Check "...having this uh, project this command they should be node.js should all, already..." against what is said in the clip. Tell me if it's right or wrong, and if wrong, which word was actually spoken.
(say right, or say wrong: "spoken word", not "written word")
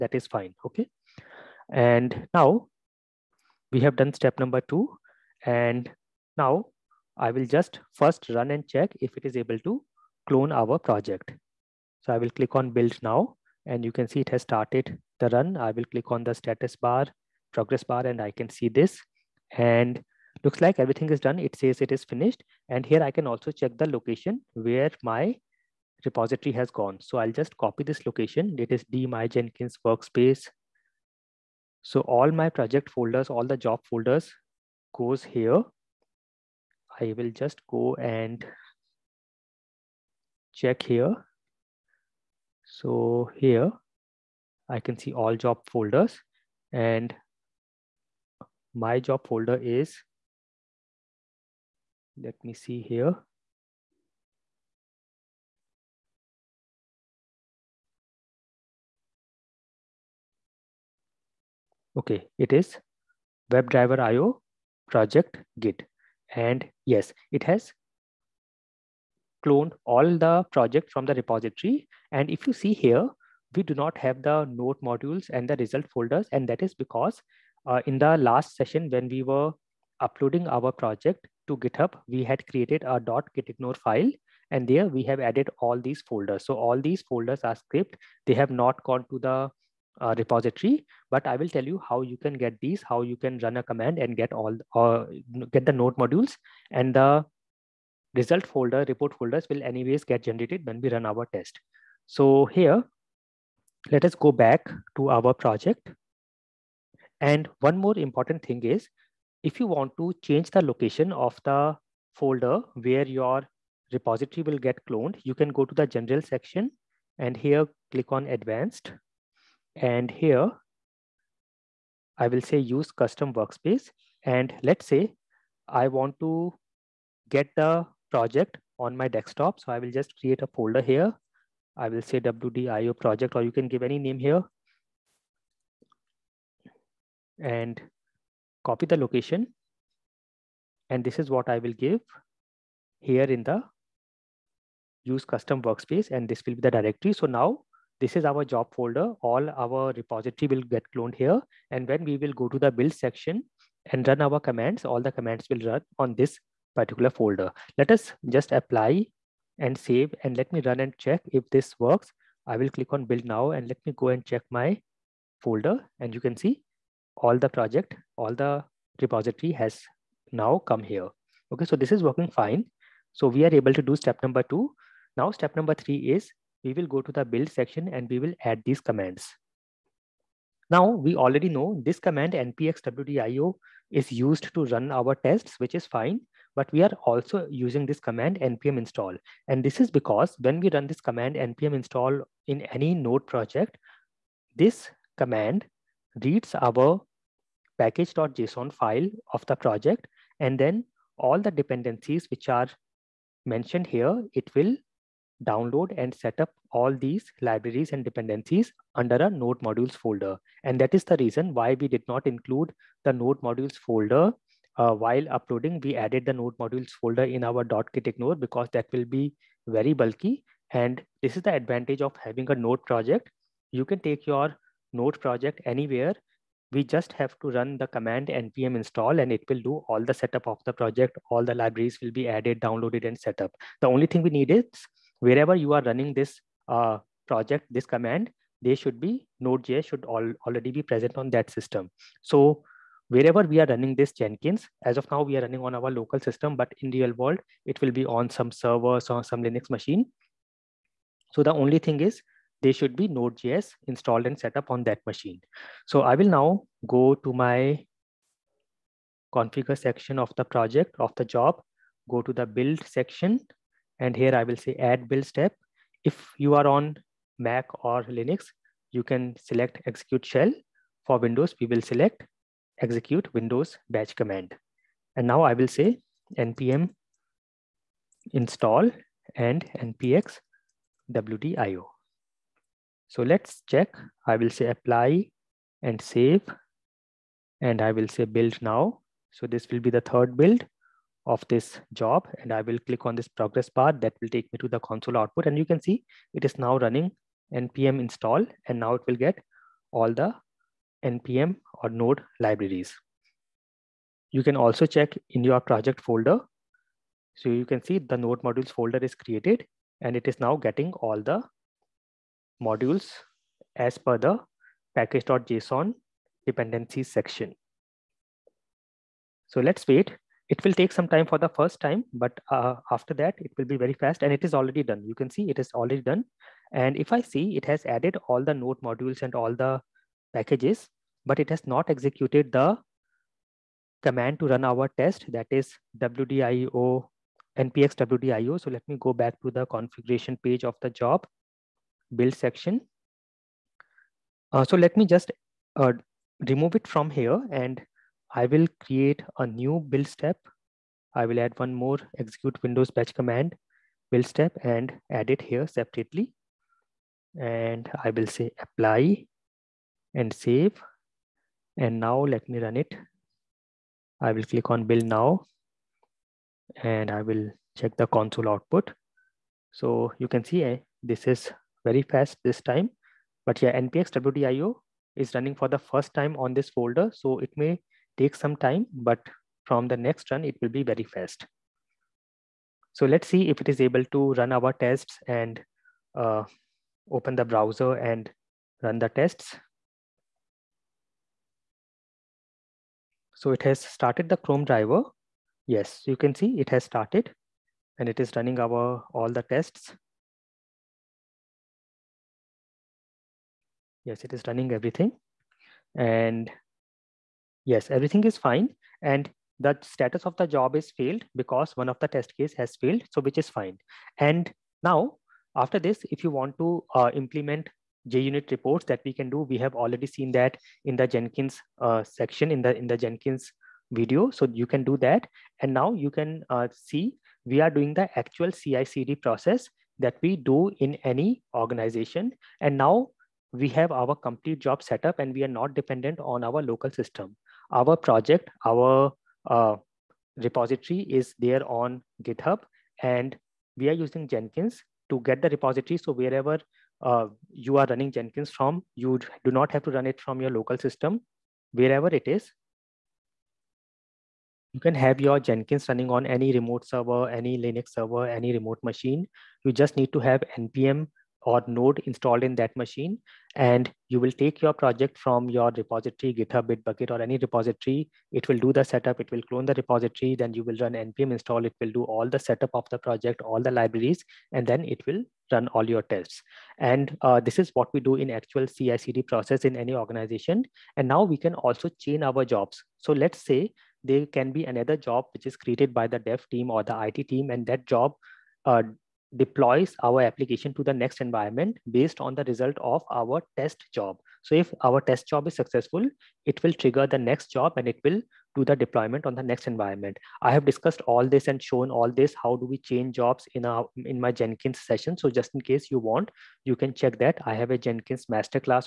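wrong: "running", not "having".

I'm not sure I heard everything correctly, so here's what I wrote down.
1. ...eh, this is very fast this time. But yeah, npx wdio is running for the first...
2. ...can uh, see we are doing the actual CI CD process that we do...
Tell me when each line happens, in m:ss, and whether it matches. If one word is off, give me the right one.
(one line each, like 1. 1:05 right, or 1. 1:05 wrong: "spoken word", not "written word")
1. 6:10 right
2. 7:06 right.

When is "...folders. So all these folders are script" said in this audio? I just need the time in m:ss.
1:26.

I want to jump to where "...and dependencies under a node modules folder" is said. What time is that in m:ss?
3:27.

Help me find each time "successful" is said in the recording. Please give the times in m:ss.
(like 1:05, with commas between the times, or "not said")
8:15.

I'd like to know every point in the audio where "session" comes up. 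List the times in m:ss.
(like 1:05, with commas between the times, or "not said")
1:18, 8:24.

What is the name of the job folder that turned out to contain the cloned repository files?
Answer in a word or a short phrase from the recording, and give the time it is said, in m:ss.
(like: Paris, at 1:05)
WebDriver IO project git, at 1:03.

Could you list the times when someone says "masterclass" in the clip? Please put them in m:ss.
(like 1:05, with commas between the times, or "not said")
8:28.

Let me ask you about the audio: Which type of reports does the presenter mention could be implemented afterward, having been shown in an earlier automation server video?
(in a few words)
JUnit reports.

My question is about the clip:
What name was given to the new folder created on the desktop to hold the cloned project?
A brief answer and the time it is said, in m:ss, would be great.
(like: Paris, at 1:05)
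WDIO project, at 2:12.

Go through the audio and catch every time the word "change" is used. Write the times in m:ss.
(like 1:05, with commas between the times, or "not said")
1:50, 8:22.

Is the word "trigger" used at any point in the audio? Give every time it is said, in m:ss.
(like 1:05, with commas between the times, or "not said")
8:16.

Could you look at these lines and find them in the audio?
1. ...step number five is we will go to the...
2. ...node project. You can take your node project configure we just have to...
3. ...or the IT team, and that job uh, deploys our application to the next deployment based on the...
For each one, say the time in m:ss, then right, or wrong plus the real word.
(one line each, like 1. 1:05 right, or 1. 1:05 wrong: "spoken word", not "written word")
1. 2:55 wrong: "three", not "five"
2. 3:42 wrong: "anywhere", not "configure"
3. 8:06 wrong: "environment", not "deployment".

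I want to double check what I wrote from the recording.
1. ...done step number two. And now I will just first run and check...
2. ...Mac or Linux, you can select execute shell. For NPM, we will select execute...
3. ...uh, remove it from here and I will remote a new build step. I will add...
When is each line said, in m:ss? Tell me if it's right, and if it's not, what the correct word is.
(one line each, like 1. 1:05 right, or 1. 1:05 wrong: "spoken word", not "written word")
1. 0:03 right
2. 4:27 wrong: "Windows", not "NPM"
3. 5:45 wrong: "create", not "remote".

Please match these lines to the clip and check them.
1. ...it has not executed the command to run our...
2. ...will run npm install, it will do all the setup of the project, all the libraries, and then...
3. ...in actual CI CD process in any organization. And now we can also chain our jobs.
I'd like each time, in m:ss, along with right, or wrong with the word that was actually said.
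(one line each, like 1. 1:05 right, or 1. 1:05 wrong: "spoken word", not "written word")
1. 5:31 right
2. 7:50 right
3. 7:58 right.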